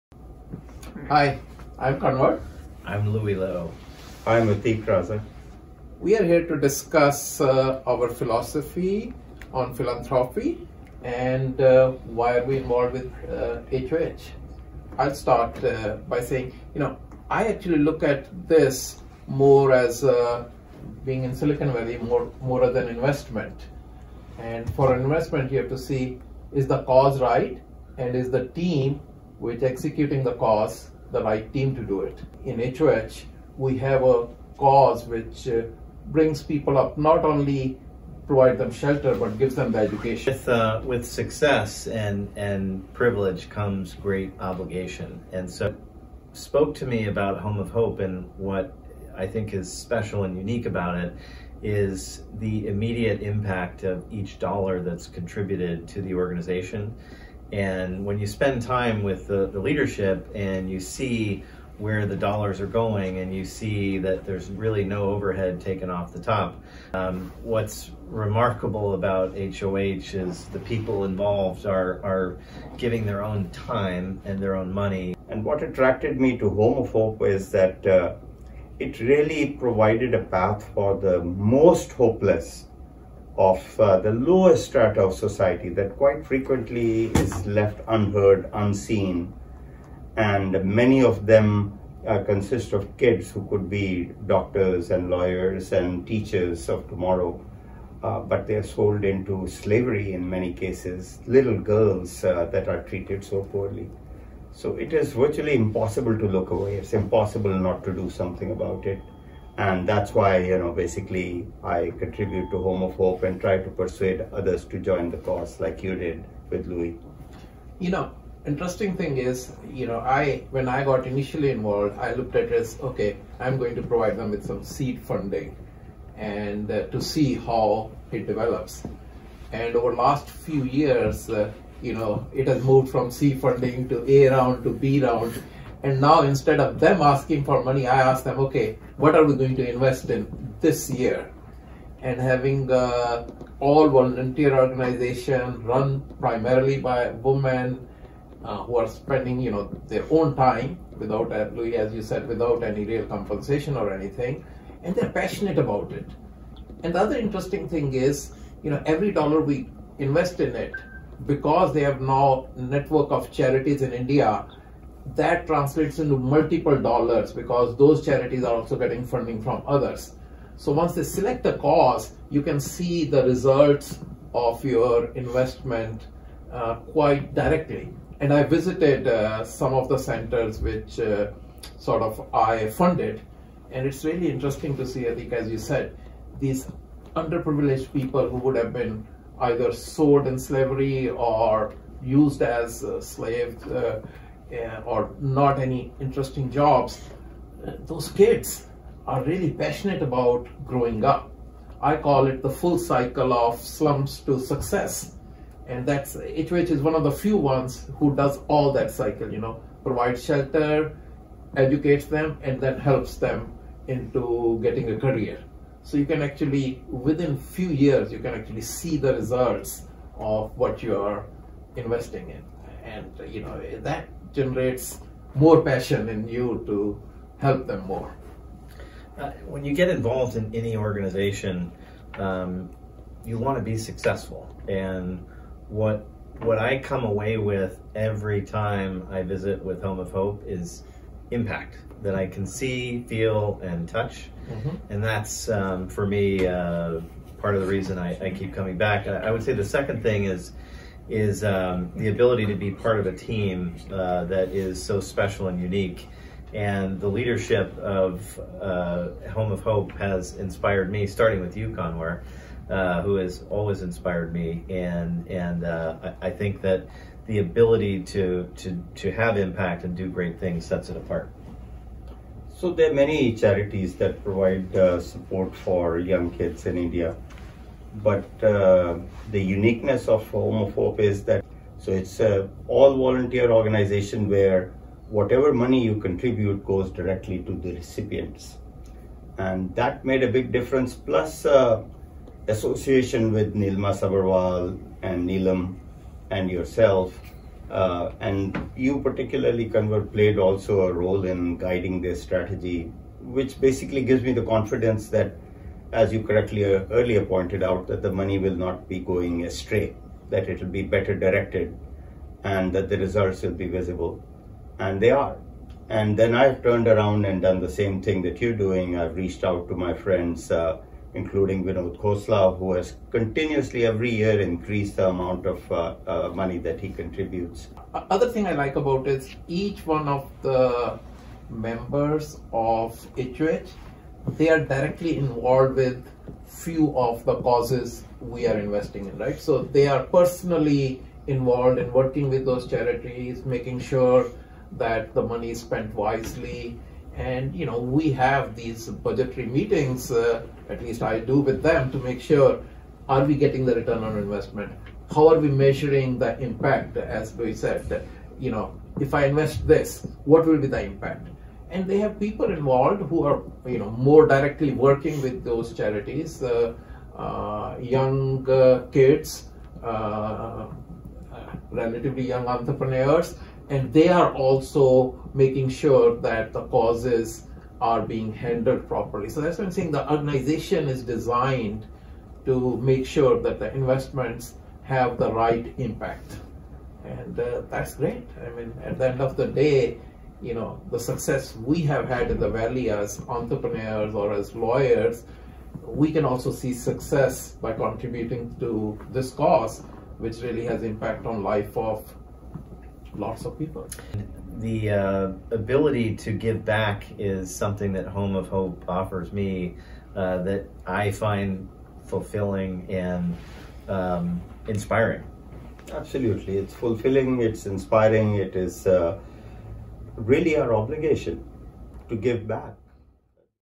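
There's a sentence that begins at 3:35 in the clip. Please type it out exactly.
So you can actually, within few years, you can actually see the results of what you are investing in.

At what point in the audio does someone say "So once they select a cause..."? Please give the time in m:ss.
2:50.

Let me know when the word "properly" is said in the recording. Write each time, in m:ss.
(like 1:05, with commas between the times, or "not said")
6:18.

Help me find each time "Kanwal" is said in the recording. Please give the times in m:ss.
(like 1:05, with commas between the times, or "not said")
0:01, 4:21, 4:59.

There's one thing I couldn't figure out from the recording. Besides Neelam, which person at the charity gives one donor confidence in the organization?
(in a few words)
Nilma Sabarwal.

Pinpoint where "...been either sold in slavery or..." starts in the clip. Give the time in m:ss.
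3:08.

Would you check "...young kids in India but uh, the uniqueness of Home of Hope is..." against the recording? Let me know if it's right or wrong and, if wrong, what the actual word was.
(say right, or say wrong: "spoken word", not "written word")
right.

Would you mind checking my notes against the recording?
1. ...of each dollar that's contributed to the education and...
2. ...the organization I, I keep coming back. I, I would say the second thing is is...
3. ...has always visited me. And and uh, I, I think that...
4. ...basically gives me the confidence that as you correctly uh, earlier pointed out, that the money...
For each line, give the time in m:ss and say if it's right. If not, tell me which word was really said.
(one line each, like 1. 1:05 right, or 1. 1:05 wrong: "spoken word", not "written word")
1. 0:53 wrong: "organization", not "education"
2. 4:07 wrong: "reason", not "organization"
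3. 4:23 wrong: "inspired", not "visited"
4. 5:03 right.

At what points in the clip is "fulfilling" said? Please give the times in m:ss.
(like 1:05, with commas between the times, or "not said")
6:52, 6:56.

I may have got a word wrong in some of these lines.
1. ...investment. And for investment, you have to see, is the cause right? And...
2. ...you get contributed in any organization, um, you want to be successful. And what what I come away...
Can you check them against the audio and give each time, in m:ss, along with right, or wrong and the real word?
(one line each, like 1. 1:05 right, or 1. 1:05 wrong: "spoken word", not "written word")
1. 0:22 right
2. 3:49 wrong: "involved", not "contributed".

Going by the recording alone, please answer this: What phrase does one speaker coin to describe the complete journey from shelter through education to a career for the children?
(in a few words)
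slums to success.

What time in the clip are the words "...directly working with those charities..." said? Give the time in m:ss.
6:04.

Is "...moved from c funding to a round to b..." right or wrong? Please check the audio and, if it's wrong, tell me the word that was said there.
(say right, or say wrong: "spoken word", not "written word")
right.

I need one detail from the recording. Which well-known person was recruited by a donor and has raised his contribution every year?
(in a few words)
Vinod Khosla.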